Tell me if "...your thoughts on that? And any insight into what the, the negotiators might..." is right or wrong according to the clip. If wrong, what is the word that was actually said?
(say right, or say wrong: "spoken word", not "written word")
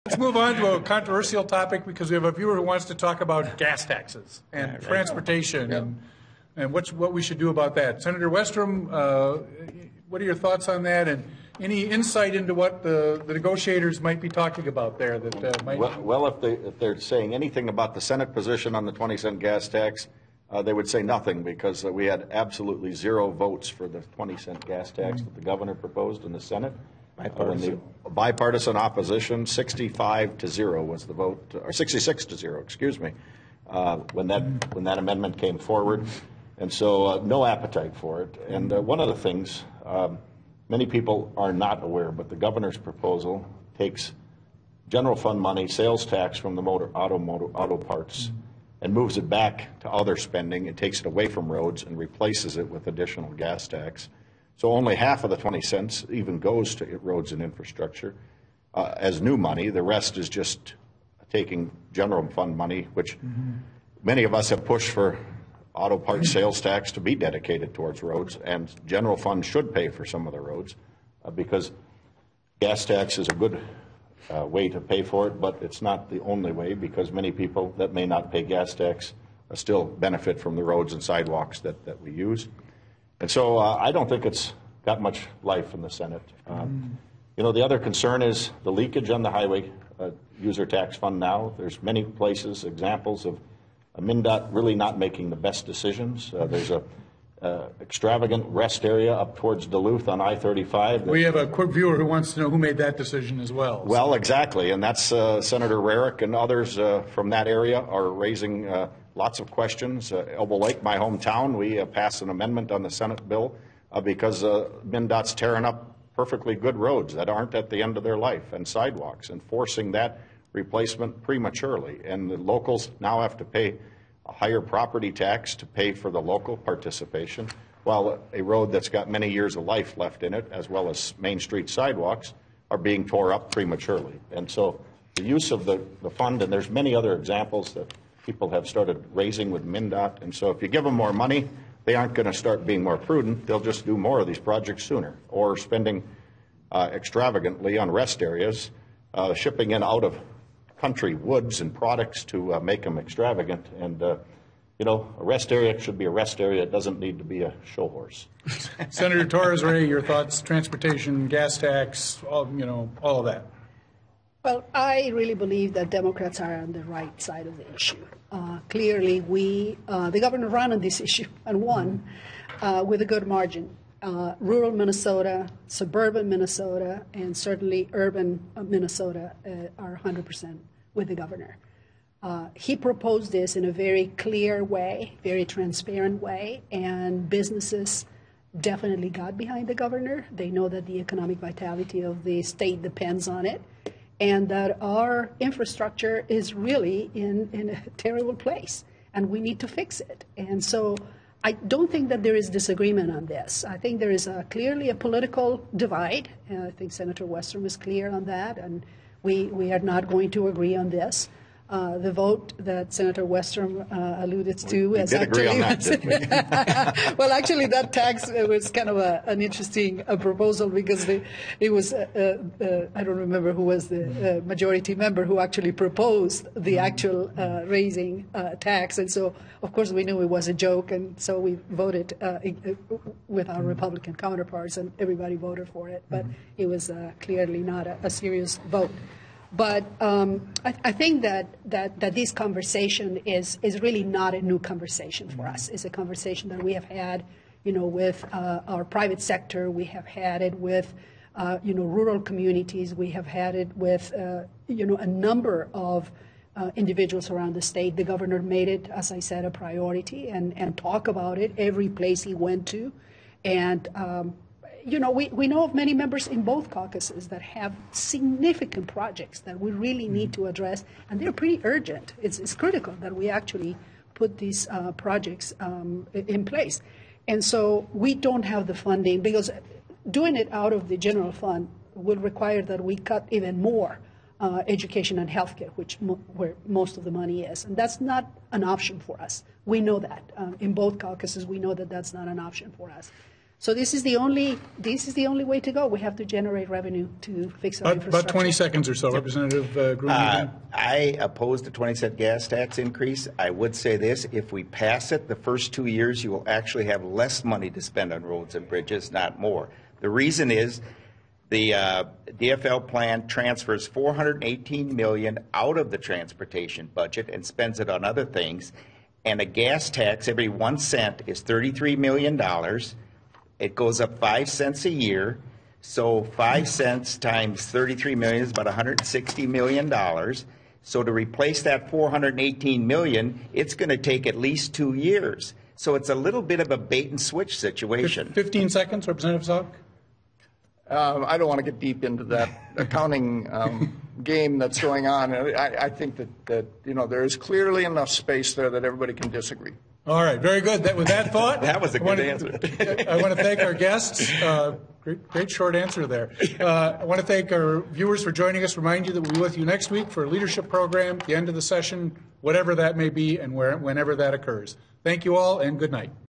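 right.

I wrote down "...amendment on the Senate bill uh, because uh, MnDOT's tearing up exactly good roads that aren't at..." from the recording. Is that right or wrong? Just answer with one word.
wrong.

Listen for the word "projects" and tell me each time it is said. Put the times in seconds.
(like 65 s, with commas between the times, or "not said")
144 s, 268 s, 274 s.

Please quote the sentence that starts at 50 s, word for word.
It takes it away from roads and replaces it with additional gas tax.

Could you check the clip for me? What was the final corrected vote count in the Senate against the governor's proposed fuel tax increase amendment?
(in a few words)
66 to 0.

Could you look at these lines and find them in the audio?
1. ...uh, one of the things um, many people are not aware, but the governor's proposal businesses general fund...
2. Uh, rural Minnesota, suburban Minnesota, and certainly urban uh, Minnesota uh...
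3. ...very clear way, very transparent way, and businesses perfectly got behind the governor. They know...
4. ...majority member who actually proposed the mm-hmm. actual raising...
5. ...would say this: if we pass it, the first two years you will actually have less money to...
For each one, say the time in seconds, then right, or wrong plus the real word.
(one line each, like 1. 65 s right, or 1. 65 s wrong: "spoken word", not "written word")
1. 38 s wrong: "takes", not "businesses"
2. 174 s right
3. 183 s wrong: "definitely", not "perfectly"
4. 224 s right
5. 303 s right.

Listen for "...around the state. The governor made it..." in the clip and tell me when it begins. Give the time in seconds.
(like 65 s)
257 s.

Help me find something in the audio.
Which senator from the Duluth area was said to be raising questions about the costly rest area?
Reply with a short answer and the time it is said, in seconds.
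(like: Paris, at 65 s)
Senator Rarick, at 105 s.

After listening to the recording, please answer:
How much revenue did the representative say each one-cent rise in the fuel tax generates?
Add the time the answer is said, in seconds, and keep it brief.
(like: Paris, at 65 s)
33 million dollars, at 321 s.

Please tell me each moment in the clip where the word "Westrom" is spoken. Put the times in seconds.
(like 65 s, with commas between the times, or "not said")
8 s, 207 s, 213 s.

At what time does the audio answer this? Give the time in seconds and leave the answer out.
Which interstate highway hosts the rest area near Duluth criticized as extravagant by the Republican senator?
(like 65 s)
100 s.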